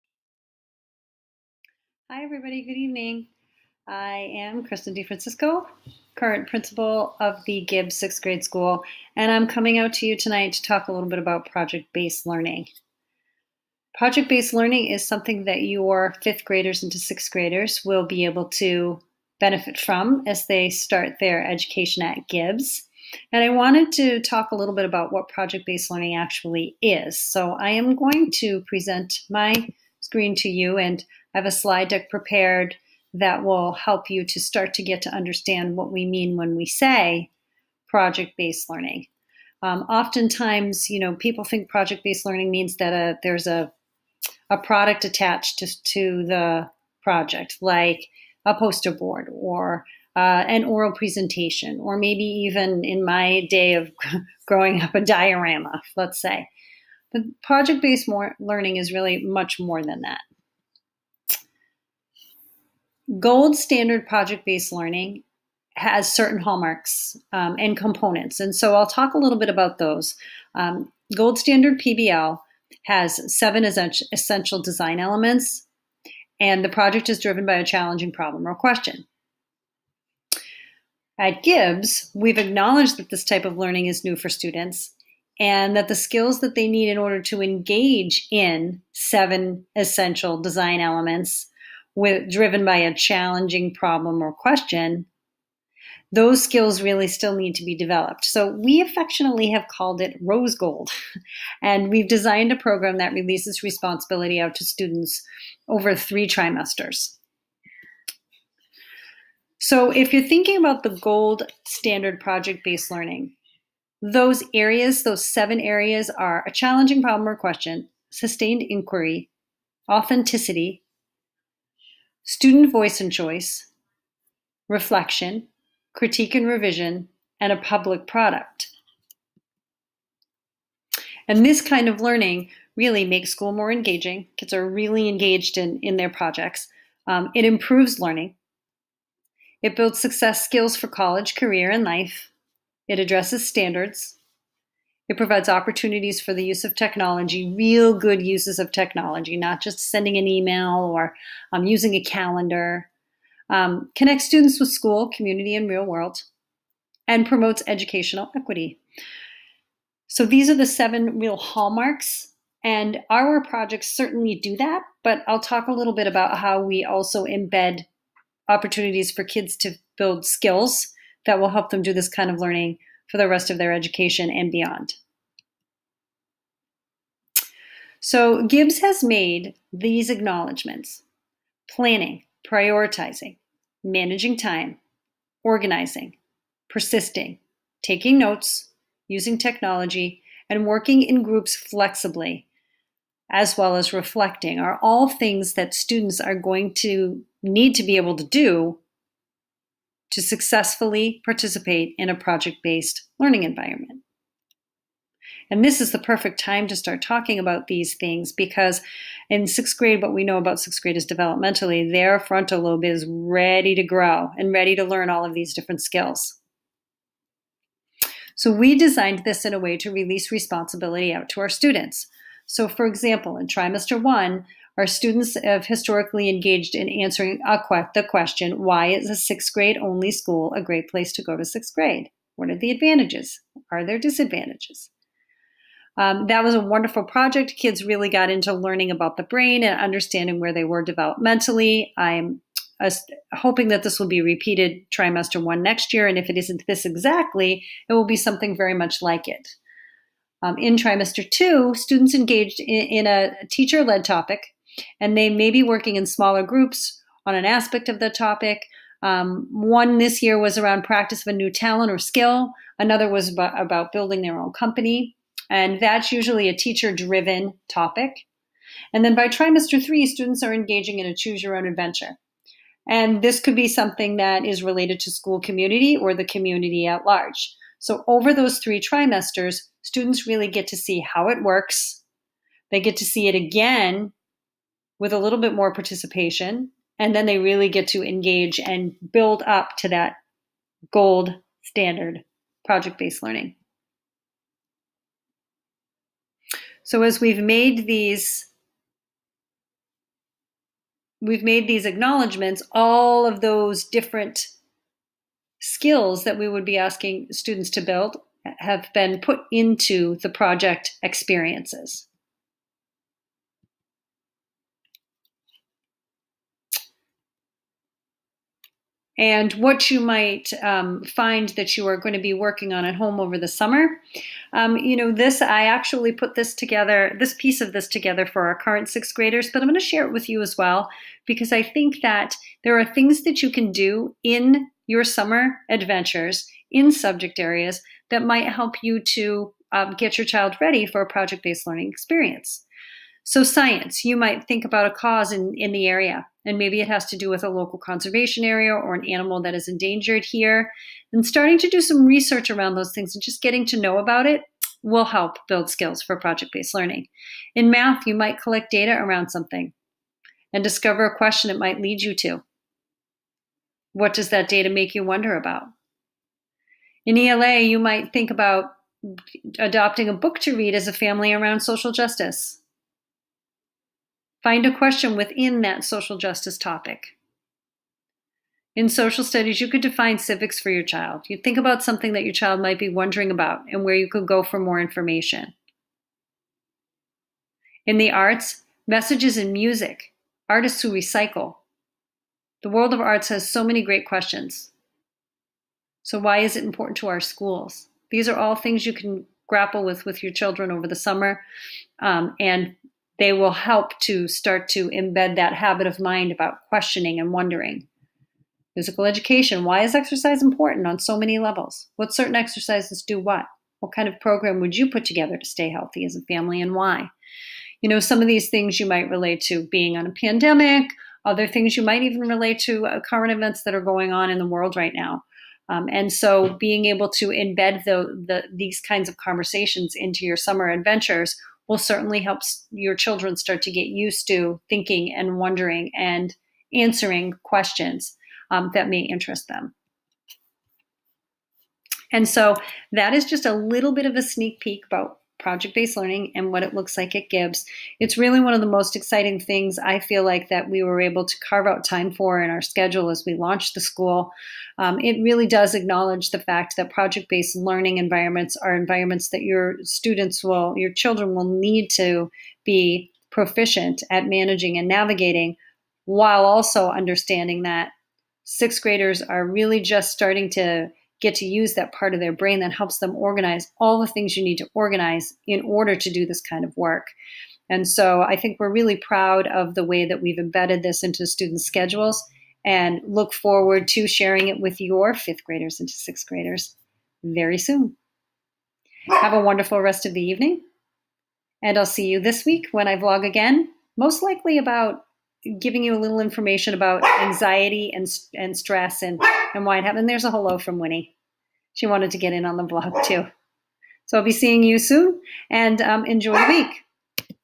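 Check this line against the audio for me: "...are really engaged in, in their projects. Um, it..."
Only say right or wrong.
right.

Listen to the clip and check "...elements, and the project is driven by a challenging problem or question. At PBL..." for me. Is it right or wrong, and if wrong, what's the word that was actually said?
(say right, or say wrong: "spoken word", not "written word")
wrong: "Gibbs", not "PBL".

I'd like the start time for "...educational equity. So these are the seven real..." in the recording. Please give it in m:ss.
2:37.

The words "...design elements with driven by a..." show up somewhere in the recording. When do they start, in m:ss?
1:30.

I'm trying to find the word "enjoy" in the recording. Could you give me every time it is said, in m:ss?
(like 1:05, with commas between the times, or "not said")
8:26.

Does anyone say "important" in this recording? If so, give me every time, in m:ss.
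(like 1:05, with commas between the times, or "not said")
6:36, 6:50.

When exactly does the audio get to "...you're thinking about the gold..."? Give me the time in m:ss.
1:50.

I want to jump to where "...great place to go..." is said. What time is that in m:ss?
3:50.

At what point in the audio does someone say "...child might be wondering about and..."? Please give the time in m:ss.
6:22.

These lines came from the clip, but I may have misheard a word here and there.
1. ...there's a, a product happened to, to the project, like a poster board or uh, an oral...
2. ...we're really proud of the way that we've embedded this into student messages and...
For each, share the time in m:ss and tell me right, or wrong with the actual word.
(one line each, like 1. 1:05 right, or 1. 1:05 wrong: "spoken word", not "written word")
1. 0:43 wrong: "attached", not "happened"
2. 7:58 wrong: "schedules", not "messages".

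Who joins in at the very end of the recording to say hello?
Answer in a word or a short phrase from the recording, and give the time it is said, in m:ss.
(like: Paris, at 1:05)
Winnie, at 8:20.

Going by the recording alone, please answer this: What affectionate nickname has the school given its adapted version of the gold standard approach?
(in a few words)
rose gold.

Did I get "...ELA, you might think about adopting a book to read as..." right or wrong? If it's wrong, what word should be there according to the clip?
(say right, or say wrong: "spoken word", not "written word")
right.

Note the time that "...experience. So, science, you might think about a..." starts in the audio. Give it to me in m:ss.
5:41.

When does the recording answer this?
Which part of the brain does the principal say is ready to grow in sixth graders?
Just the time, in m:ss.
3:32.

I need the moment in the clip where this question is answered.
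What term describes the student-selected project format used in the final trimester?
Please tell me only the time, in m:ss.
4:31.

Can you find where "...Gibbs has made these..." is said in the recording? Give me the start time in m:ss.
2:58.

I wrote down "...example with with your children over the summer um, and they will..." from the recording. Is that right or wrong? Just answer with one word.
wrong.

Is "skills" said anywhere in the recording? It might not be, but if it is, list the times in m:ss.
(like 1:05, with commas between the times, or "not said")
1:25, 1:36, 2:20, 2:50, 3:35, 4:21, 5:05, 5:55.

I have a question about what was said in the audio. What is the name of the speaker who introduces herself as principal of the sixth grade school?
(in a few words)
Kristen DeFrancisco.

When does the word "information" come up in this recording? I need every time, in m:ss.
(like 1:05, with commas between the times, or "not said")
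6:24, 8:16.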